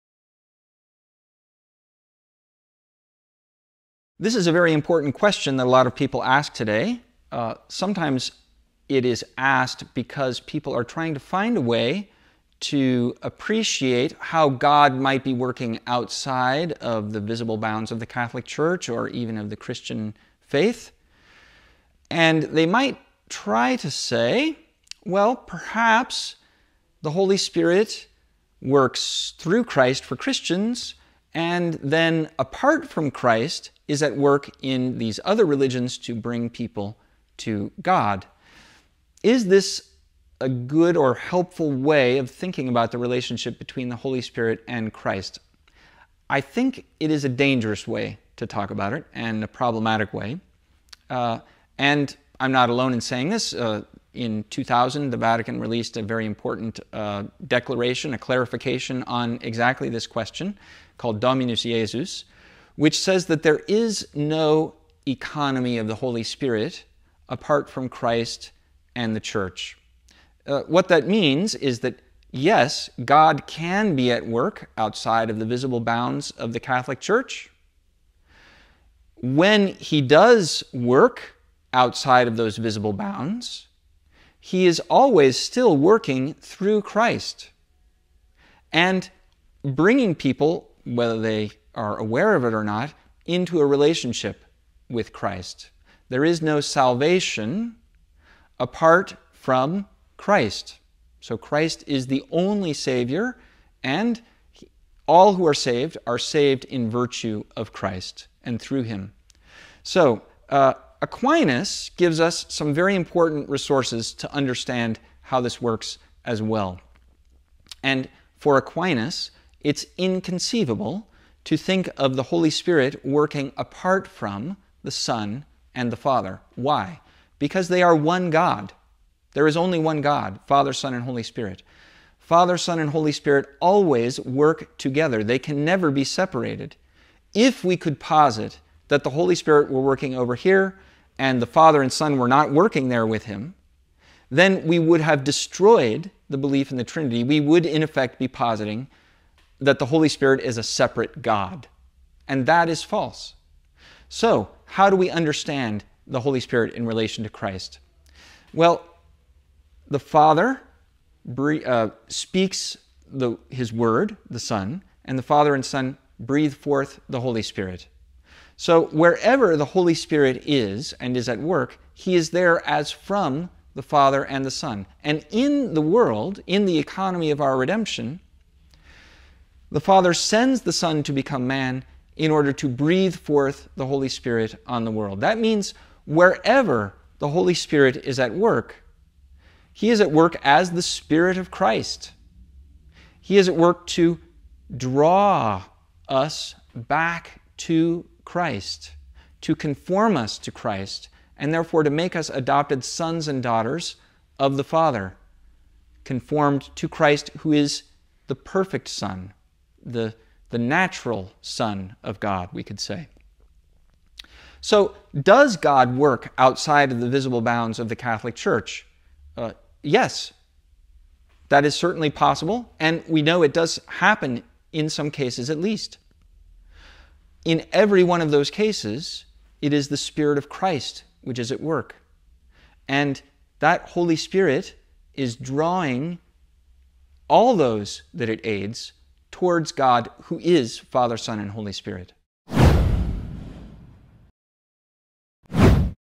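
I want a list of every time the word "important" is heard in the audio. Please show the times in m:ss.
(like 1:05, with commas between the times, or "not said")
0:04, 0:56, 1:52.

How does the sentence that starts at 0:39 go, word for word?
Is this a good or helpful way of thinking about the relationship between the Holy Spirit and Christ?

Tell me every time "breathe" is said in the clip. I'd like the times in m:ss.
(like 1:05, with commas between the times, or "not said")
2:46, 3:02.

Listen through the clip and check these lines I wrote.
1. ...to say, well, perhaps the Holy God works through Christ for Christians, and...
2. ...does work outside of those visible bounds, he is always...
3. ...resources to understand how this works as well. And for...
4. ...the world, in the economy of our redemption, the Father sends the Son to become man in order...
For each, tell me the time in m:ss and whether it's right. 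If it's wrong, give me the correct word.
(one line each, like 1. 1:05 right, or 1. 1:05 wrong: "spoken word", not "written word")
1. 0:23 wrong: "Spirit", not "God"
2. 1:20 right
3. 1:53 right
4. 2:55 right.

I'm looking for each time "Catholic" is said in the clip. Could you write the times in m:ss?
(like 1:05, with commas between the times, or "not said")
0:18, 1:16, 3:37.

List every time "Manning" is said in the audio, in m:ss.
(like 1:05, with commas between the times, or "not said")
not said.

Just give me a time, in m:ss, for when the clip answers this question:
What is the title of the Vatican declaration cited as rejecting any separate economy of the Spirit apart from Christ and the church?
1:01.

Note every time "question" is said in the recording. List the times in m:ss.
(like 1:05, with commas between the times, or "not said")
0:05, 1:00.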